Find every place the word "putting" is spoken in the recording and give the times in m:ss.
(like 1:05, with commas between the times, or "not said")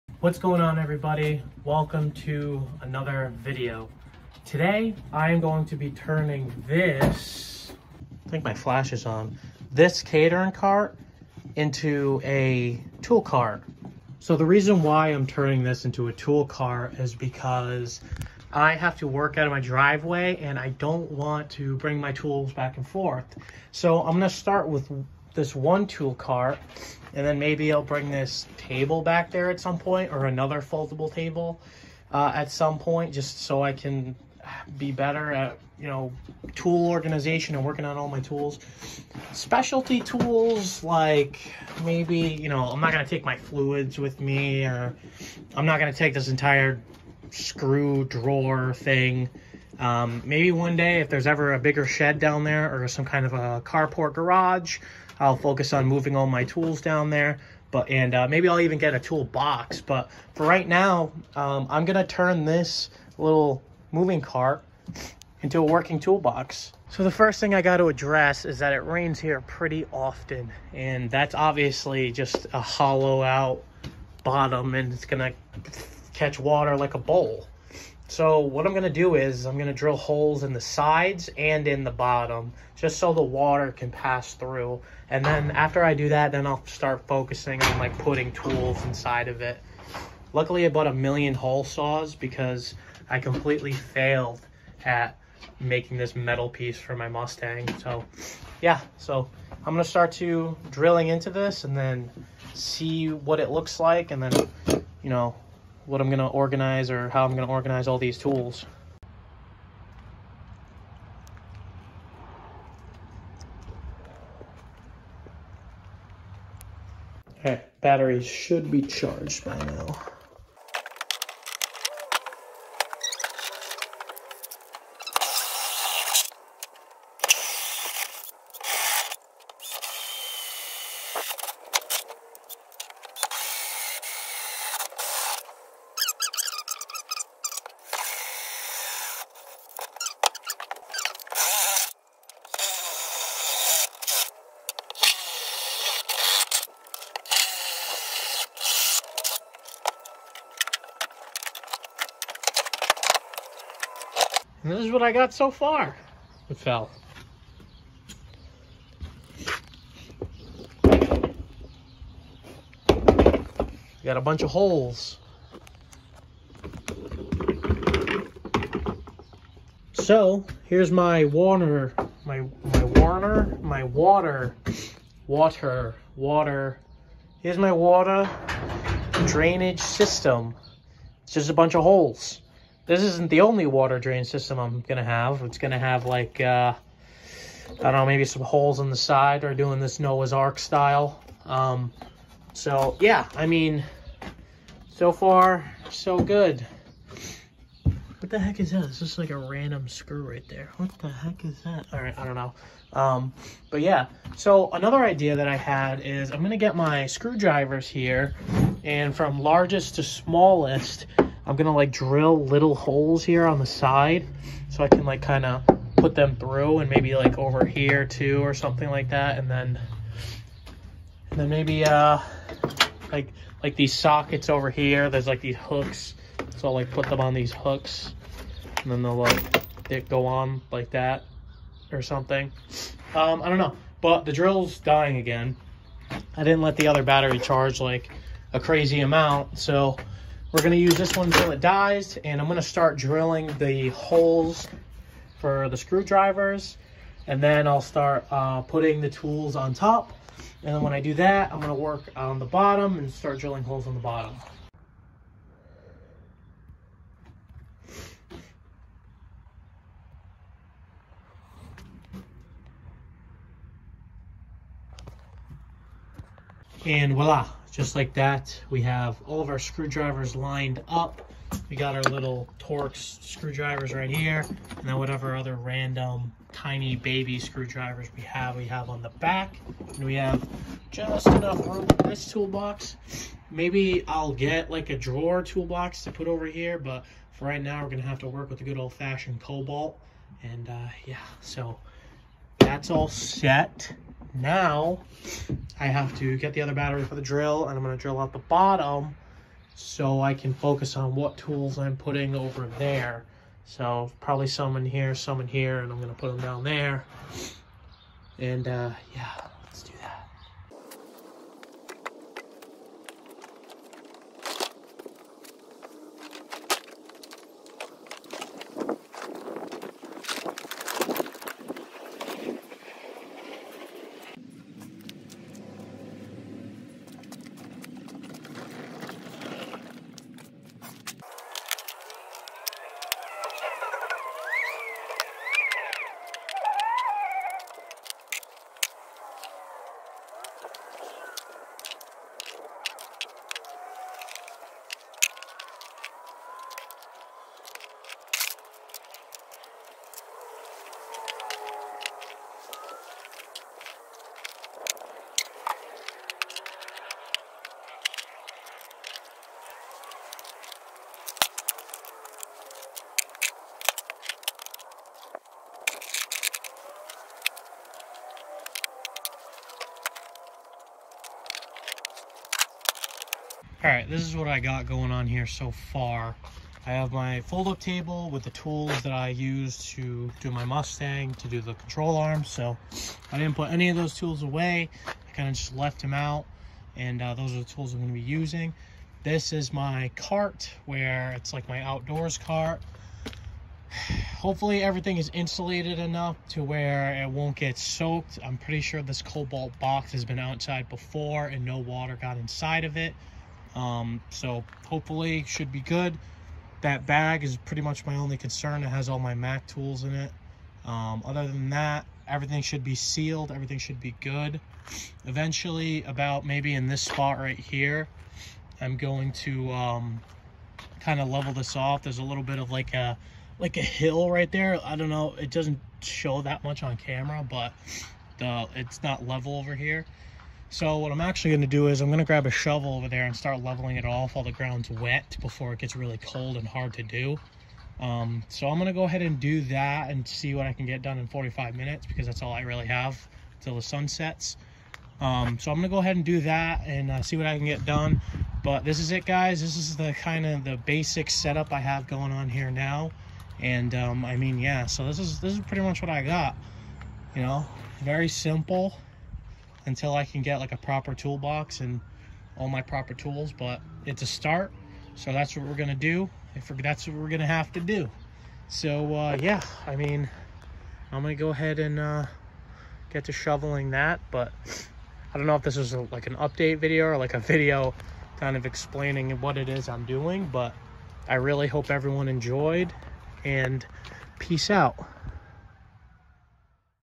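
1:27, 4:08, 5:01.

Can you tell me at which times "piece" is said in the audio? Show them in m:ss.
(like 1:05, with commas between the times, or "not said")
1:36.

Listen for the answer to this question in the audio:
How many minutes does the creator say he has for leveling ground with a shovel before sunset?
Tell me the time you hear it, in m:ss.
7:21.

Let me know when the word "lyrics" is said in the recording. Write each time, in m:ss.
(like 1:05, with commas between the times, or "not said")
not said.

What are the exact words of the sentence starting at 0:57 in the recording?
But and uh, maybe I'll even get a toolbox.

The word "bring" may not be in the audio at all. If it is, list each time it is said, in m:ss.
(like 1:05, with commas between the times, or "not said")
0:21, 0:27.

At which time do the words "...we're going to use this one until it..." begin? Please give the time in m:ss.
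4:00.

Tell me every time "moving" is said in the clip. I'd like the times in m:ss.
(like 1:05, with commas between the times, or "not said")
0:55, 1:03.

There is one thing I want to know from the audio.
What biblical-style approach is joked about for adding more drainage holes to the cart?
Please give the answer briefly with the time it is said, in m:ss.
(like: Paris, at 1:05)
Noah's Ark style, at 3:09.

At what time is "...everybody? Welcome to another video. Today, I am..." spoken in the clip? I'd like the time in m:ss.
0:00.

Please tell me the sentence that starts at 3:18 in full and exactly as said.
It's just like a random screw right there.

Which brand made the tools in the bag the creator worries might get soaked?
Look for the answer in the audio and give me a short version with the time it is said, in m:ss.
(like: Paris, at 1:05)
Mac, at 6:49.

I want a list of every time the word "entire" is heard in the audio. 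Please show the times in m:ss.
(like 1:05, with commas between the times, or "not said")
0:46.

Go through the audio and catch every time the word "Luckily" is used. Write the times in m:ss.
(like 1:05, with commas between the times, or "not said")
1:30.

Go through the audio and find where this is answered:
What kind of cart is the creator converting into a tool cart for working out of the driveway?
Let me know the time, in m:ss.
0:10.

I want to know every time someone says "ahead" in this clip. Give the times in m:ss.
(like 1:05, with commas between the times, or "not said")
7:19, 7:25, 7:51.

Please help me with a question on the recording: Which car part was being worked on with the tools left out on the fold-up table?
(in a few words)
Control arm.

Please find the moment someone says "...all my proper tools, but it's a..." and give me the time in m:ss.
7:42.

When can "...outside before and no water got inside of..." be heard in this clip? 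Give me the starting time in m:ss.
6:40.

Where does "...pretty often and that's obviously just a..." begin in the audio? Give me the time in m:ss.
1:09.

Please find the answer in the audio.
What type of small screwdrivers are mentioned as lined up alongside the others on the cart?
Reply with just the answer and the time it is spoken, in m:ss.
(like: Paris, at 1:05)
Torx, at 4:32.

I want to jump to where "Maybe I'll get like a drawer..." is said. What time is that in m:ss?
4:43.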